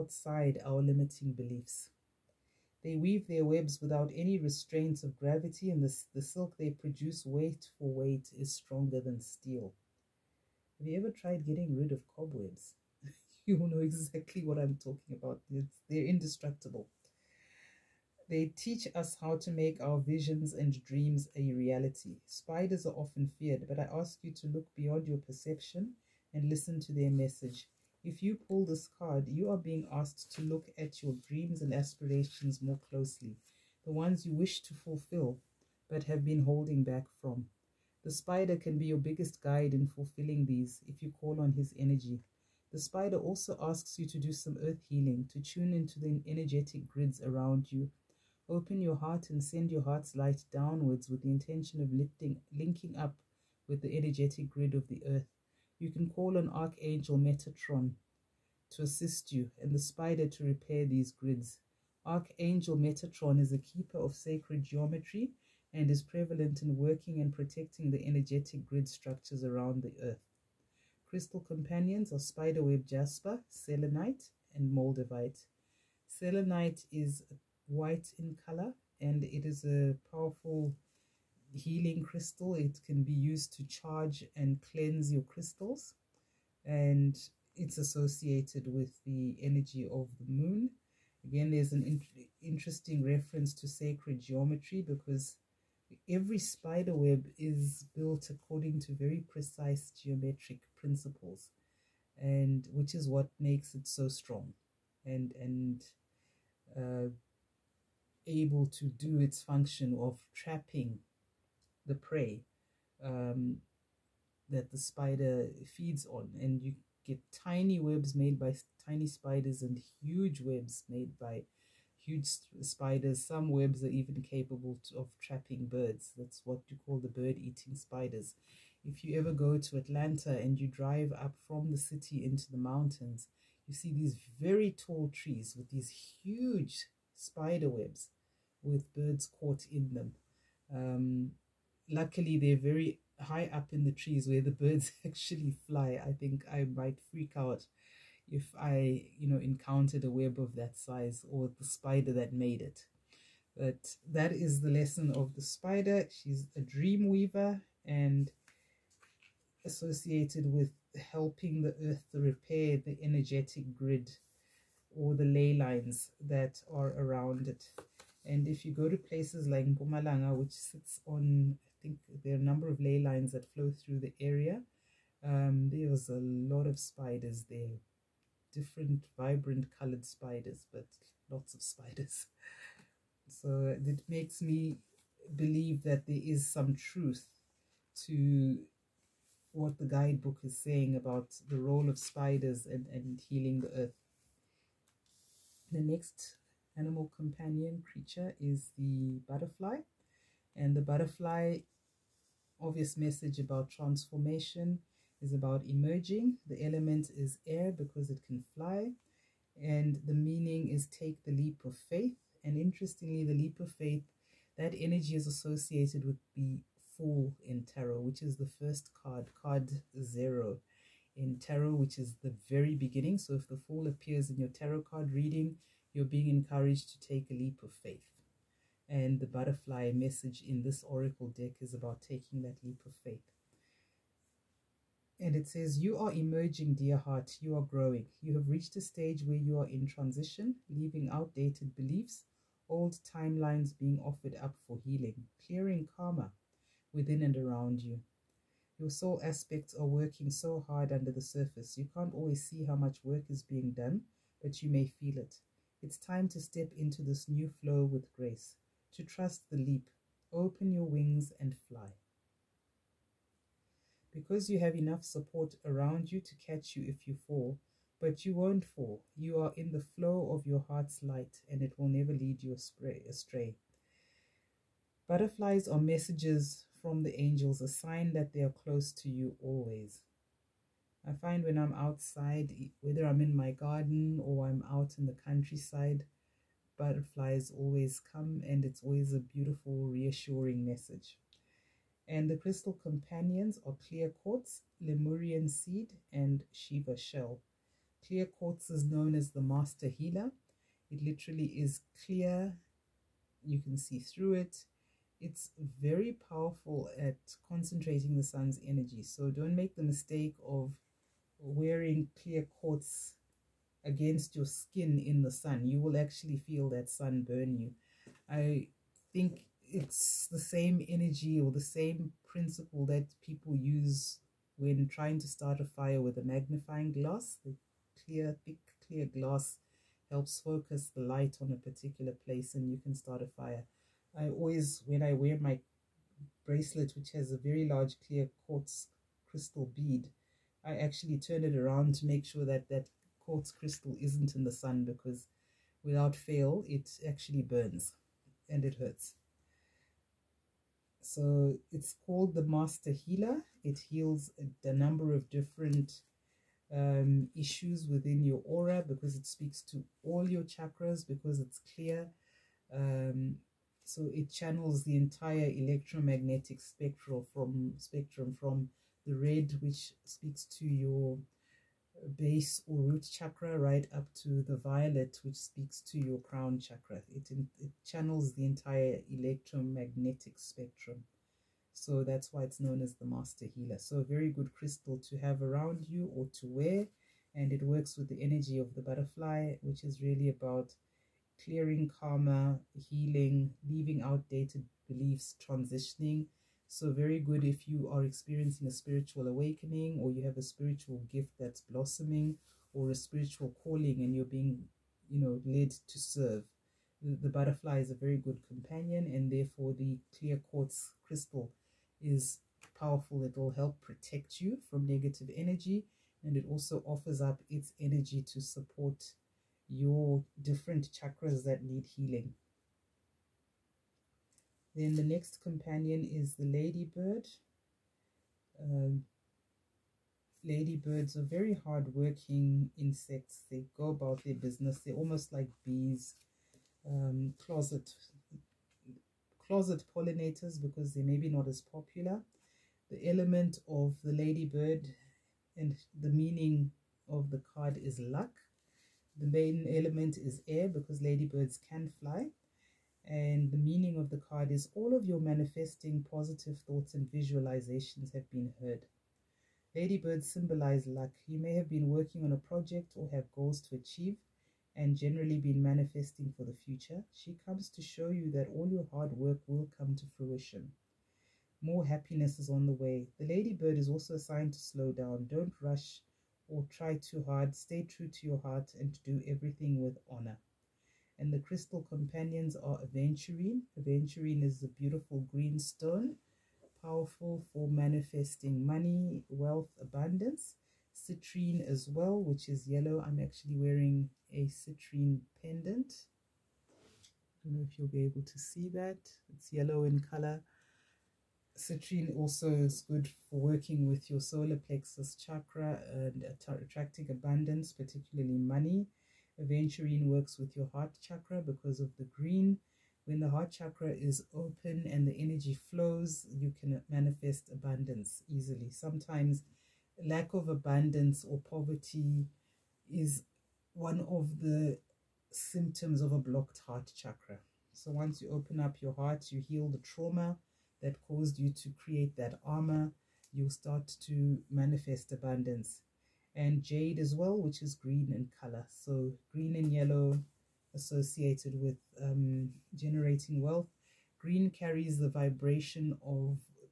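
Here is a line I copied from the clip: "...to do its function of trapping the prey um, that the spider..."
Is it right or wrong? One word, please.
right.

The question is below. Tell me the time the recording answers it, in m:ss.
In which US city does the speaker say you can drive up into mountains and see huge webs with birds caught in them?
2:09.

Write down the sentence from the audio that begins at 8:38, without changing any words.
Sometimes lack of abundance or poverty is one of the symptoms of a blocked heart chakra.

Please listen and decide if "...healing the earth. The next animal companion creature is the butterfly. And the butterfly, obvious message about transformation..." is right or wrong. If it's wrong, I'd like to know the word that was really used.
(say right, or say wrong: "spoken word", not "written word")
right.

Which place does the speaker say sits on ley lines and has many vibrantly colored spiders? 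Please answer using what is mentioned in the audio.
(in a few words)
Mpumalanga.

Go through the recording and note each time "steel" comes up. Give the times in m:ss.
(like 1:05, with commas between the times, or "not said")
0:09.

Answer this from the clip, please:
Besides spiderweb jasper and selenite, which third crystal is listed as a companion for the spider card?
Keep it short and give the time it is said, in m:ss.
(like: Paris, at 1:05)
Moldavite, at 1:14.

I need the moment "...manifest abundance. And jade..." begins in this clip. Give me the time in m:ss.
8:54.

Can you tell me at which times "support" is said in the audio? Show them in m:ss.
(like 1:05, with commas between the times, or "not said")
4:25, 6:58.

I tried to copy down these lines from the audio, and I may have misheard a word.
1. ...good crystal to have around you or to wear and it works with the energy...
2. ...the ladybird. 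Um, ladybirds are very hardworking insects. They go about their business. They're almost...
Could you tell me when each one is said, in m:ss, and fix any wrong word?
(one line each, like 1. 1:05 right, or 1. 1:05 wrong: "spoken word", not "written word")
1. 6:24 right
2. 7:06 right.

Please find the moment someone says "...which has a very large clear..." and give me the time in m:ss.
5:36.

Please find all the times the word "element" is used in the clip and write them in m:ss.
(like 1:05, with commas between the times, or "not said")
3:26, 7:23, 7:29.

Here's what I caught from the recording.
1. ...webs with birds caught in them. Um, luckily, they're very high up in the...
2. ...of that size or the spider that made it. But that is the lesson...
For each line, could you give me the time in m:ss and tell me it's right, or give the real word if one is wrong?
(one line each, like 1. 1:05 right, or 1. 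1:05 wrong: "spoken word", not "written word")
1. 2:17 right
2. 2:30 right.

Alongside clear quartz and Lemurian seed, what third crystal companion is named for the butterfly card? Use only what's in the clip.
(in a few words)
Shiva shell.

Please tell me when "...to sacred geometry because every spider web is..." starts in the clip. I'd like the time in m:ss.
1:33.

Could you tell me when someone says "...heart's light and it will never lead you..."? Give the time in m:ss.
4:30.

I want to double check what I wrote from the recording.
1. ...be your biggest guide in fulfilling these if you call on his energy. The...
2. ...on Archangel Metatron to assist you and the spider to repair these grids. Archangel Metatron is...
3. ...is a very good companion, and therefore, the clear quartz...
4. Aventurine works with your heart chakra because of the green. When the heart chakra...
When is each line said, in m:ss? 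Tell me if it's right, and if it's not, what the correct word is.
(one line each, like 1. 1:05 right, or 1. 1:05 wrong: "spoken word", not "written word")
1. 0:38 right
2. 0:56 right
3. 6:47 right
4. 8:29 right.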